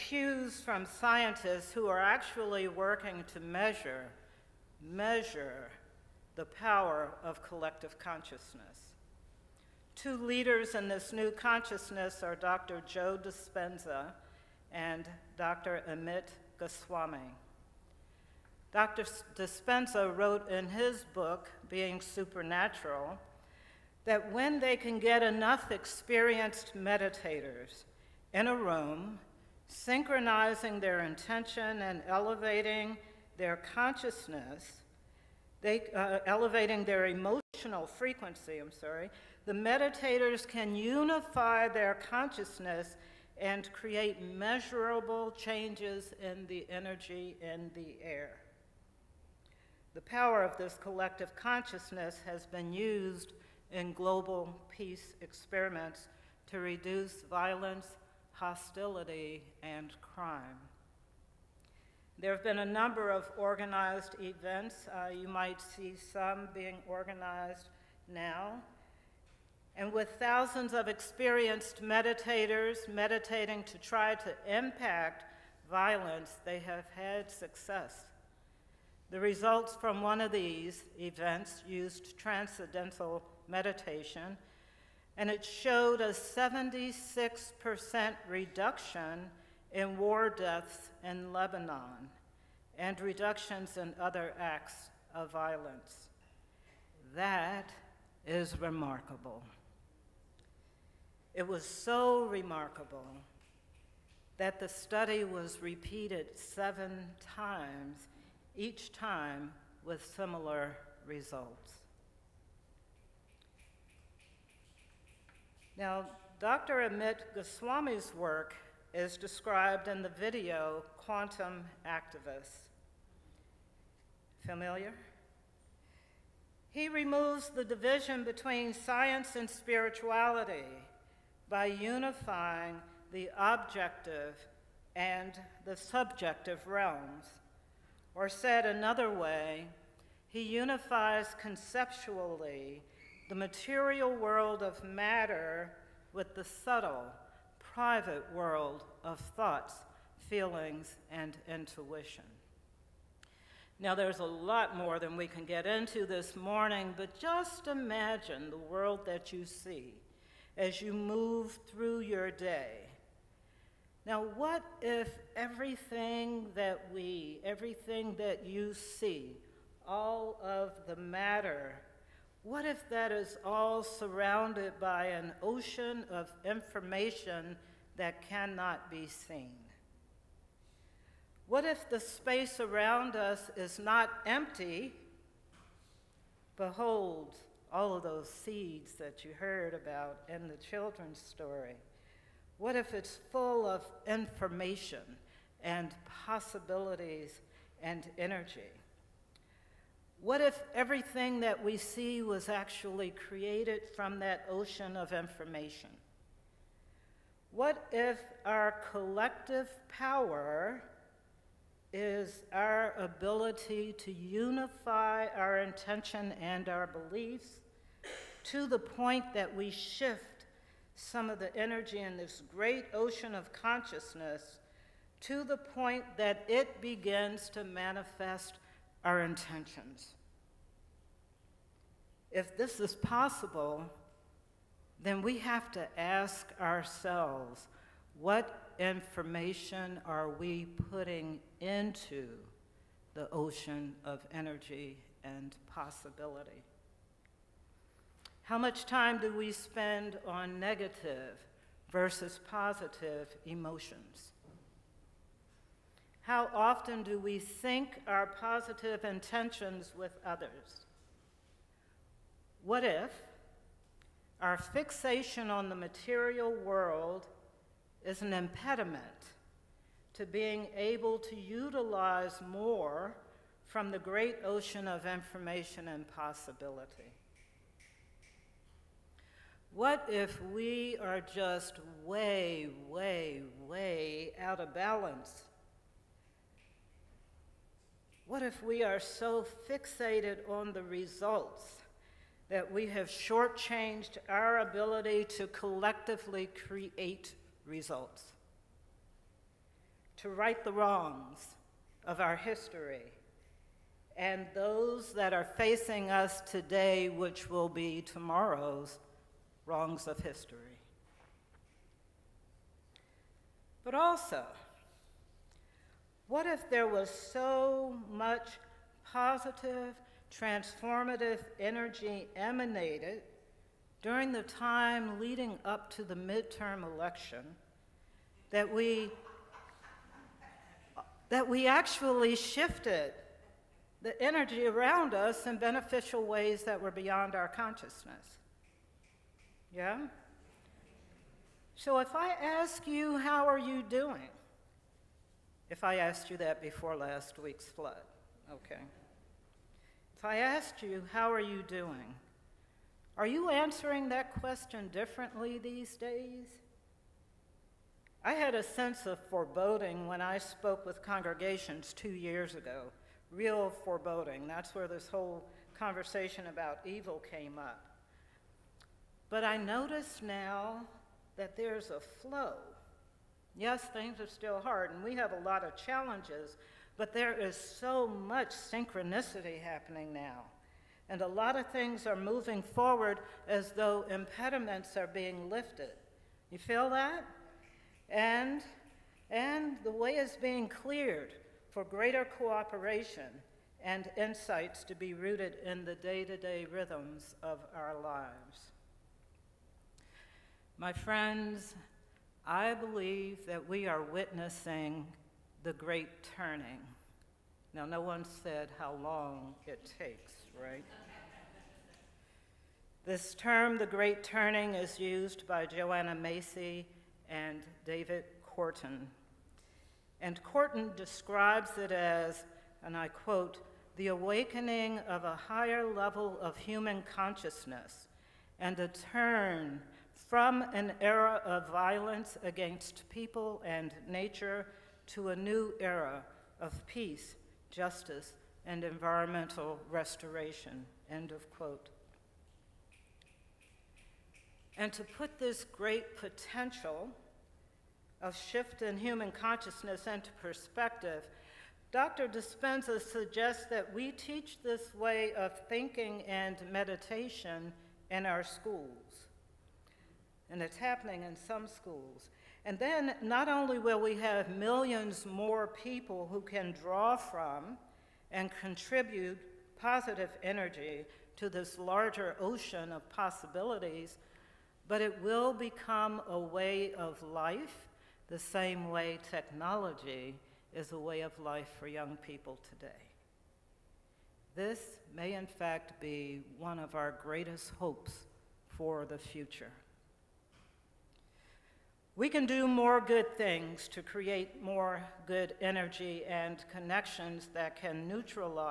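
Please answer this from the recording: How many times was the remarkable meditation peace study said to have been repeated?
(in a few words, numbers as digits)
7.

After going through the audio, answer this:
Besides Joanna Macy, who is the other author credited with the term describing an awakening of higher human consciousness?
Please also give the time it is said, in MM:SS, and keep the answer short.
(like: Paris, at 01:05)
David Korten, at 06:57.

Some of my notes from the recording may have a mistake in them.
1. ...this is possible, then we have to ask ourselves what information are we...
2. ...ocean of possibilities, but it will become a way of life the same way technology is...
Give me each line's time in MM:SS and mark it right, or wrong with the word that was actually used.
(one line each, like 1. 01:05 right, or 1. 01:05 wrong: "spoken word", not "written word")
1. 03:52 right
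2. 07:52 right.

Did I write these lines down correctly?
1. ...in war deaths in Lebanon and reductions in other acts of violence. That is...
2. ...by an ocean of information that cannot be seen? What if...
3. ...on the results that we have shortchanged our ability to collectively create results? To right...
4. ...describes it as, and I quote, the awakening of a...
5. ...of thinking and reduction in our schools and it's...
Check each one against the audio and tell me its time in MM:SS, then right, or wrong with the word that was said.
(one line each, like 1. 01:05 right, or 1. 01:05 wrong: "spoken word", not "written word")
1. 01:29 right
2. 02:54 right
3. 04:50 right
4. 07:00 right
5. 07:35 wrong: "meditation", not "reduction".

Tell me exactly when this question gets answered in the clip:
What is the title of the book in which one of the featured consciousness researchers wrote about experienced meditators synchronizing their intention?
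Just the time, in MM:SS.
00:21.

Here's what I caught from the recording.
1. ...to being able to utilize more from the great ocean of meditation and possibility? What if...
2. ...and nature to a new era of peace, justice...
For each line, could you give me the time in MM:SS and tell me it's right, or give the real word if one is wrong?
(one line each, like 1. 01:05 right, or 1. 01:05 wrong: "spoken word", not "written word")
1. 04:30 wrong: "information", not "meditation"
2. 07:13 right.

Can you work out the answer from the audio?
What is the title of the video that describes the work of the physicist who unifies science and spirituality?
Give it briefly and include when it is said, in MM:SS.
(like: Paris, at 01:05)
Quantum Activists, at 02:00.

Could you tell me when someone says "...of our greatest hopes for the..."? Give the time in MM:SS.
08:06.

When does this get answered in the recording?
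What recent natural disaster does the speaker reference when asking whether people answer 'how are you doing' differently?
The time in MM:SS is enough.
05:47.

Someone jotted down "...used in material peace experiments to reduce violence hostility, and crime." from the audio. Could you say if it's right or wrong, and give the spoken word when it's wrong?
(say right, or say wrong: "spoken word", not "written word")
wrong: "global", not "material".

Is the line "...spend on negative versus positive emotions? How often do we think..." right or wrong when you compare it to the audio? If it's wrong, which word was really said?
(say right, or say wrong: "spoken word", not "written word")
right.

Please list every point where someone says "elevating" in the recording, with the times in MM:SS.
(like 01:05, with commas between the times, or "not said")
00:32, 00:36.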